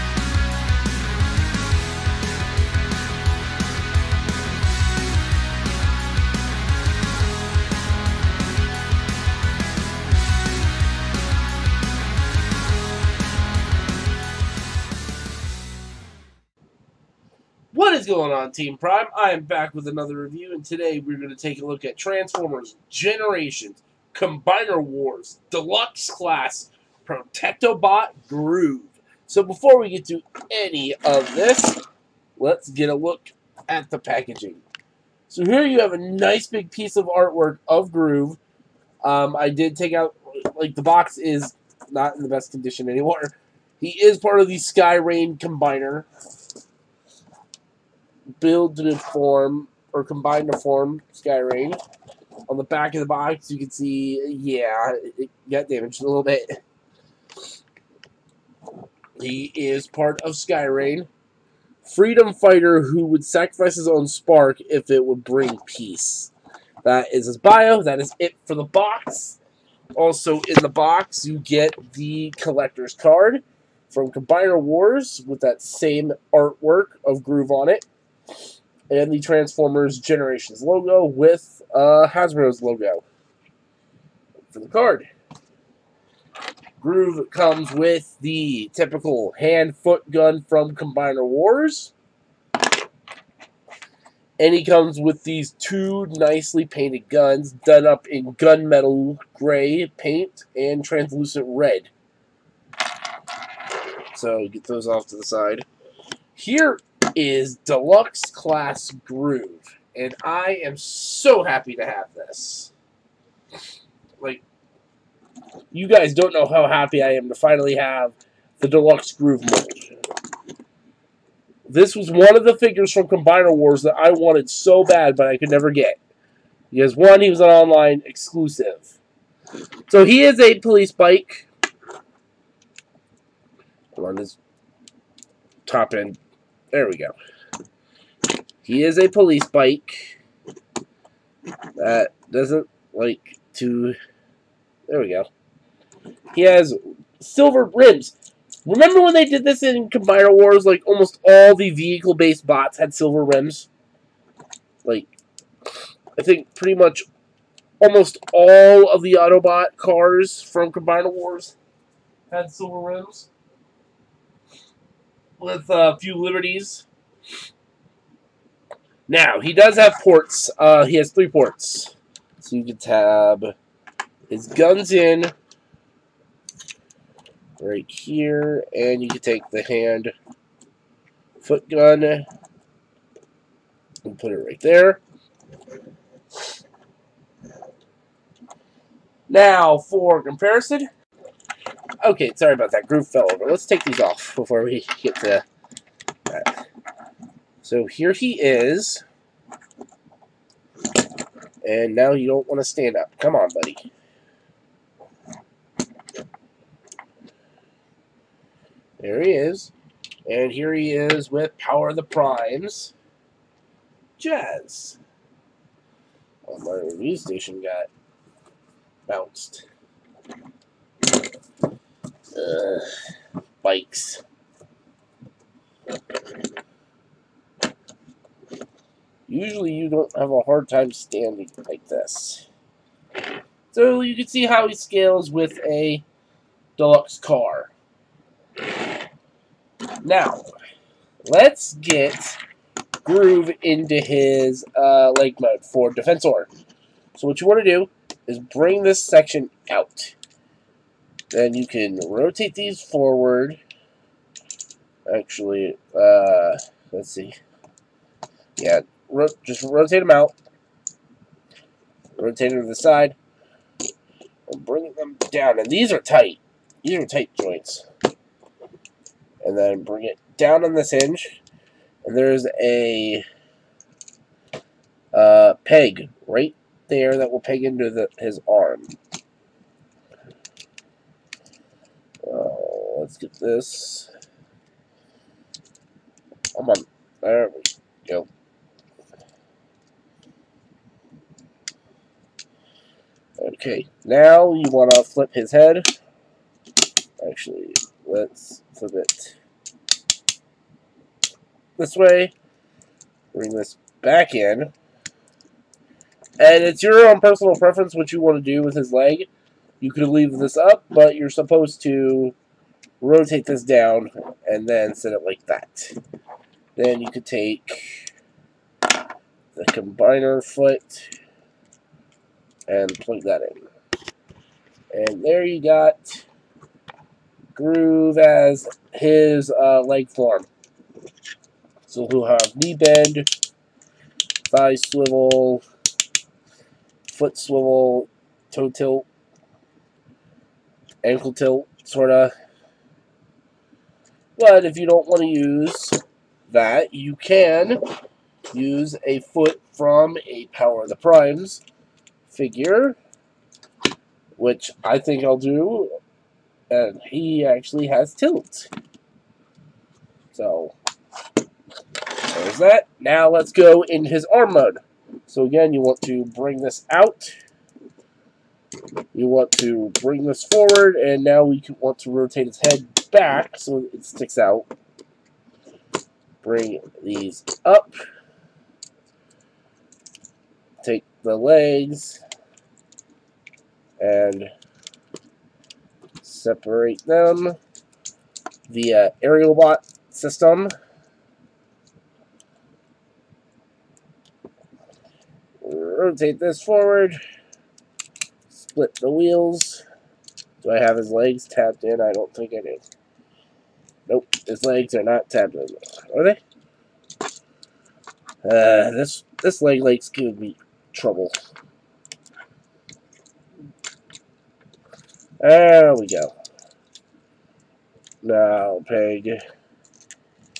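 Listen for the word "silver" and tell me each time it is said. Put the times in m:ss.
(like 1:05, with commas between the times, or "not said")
2:27, 2:32, 2:42.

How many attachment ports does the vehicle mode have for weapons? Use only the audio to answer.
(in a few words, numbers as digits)
3.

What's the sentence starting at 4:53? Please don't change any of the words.
Okay, now you want to flip his head.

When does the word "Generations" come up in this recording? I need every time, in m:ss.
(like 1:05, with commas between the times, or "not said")
0:22, 1:19.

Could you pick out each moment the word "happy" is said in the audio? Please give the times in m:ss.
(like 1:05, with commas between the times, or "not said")
1:51, 1:56.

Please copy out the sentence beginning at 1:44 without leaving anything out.
So get those off to the side.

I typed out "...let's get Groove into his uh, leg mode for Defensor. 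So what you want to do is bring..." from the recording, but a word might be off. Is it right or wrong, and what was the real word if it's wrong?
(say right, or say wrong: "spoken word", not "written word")
right.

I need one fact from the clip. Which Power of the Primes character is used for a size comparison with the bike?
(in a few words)
Jazz.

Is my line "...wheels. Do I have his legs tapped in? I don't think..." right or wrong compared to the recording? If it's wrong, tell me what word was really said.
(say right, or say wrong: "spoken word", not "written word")
right.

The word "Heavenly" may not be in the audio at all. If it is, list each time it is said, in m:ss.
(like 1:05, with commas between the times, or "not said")
not said.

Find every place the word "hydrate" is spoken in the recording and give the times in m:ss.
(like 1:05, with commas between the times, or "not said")
not said.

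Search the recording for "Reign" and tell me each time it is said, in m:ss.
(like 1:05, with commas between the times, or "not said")
0:44, 0:51, 1:00.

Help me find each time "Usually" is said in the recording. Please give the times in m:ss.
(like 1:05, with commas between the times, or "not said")
3:49.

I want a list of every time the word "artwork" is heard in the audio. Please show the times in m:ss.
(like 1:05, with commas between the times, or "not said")
0:37, 1:16.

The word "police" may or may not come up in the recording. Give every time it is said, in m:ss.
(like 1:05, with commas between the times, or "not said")
2:10, 2:19.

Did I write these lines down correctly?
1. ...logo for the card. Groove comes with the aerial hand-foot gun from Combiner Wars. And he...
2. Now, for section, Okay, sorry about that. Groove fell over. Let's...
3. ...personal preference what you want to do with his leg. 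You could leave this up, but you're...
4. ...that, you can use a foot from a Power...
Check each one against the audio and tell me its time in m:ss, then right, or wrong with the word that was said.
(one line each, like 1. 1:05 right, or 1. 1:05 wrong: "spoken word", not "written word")
1. 1:22 wrong: "typical", not "aerial"
2. 3:09 wrong: "comparison", not "section"
3. 5:07 right
4. 5:46 right.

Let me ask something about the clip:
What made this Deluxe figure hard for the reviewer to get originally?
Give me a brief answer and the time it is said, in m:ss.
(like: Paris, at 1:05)
online exclusive, at 2:07.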